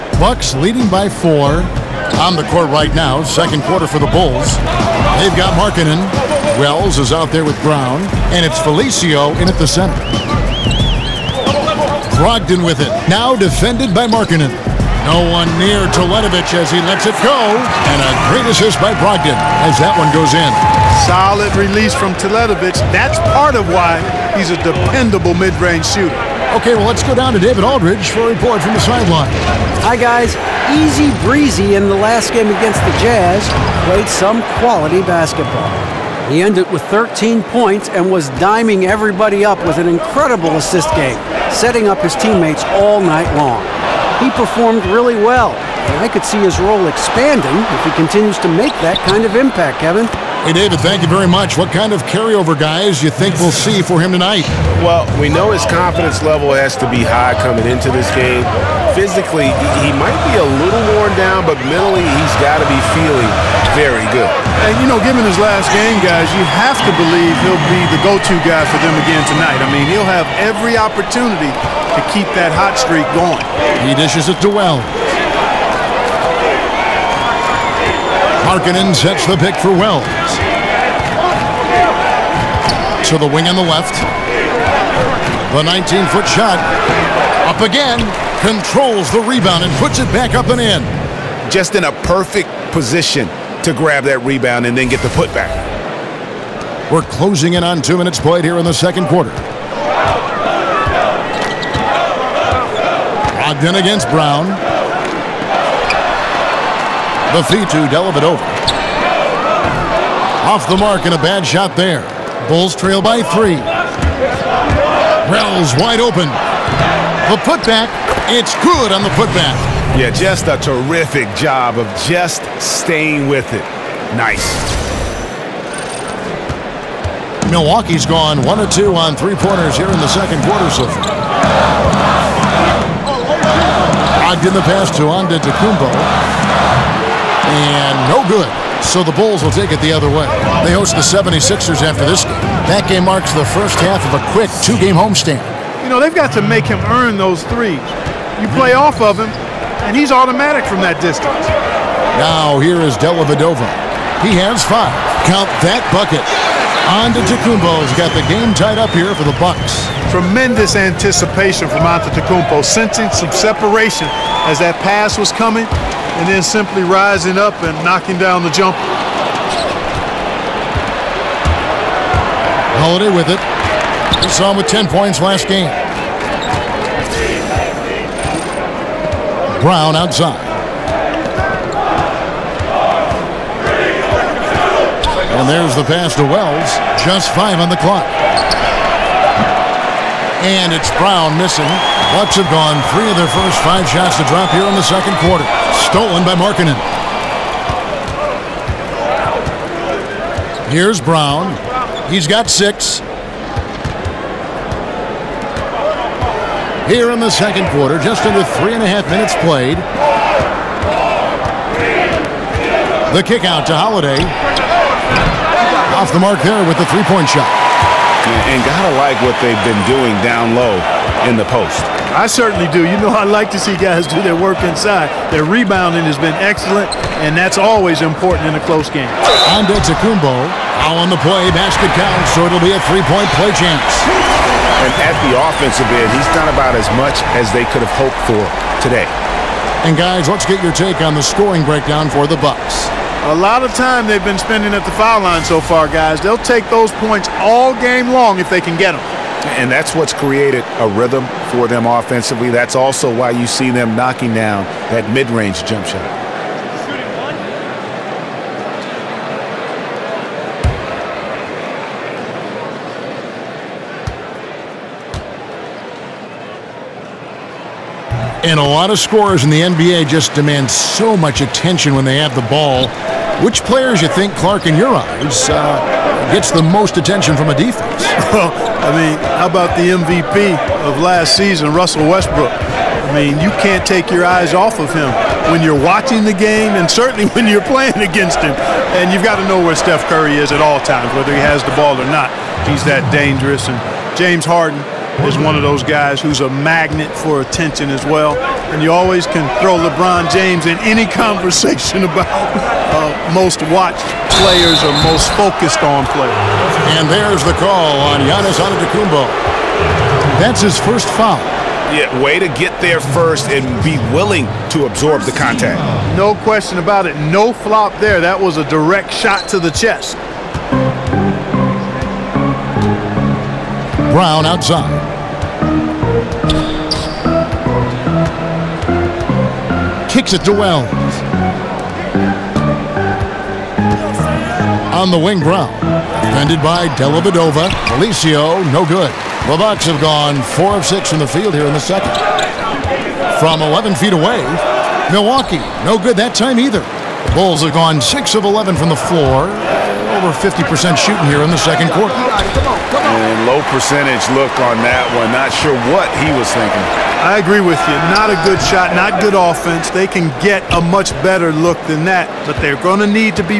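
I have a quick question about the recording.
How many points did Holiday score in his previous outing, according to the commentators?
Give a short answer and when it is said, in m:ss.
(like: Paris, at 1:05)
10, at 2:54.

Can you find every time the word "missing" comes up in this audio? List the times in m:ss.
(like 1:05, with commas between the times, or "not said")
3:11.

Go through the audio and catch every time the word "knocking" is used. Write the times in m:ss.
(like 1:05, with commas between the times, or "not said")
2:47, 4:13.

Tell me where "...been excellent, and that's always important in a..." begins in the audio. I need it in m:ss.
3:46.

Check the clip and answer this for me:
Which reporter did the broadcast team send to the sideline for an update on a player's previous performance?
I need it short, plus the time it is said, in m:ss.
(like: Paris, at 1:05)
David Aldridge, at 0:27.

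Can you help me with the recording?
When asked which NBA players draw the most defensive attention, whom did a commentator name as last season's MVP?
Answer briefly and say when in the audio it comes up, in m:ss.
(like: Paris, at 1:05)
Russell Westbrook, at 4:41.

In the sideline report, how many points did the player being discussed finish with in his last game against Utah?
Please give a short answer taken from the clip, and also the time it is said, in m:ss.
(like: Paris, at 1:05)
13, at 0:36.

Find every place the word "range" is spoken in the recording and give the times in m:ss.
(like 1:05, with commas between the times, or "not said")
0:25, 4:15.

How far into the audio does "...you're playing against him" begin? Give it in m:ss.
4:47.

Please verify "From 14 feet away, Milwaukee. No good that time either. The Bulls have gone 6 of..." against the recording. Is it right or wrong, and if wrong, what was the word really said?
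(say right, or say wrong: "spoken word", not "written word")
wrong: "11", not "14".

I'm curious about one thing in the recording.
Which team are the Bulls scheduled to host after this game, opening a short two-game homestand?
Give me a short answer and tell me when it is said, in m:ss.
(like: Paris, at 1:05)
76ers, at 2:21.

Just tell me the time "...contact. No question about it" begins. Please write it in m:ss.
5:15.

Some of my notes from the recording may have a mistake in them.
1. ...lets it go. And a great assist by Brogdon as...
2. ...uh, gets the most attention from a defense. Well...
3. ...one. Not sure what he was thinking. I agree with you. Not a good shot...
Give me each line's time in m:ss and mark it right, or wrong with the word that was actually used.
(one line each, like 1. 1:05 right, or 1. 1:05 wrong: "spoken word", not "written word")
1. 0:16 right
2. 4:35 right
3. 5:55 right.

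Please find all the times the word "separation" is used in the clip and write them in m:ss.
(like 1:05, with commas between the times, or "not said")
2:43.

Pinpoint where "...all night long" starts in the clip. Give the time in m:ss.
0:42.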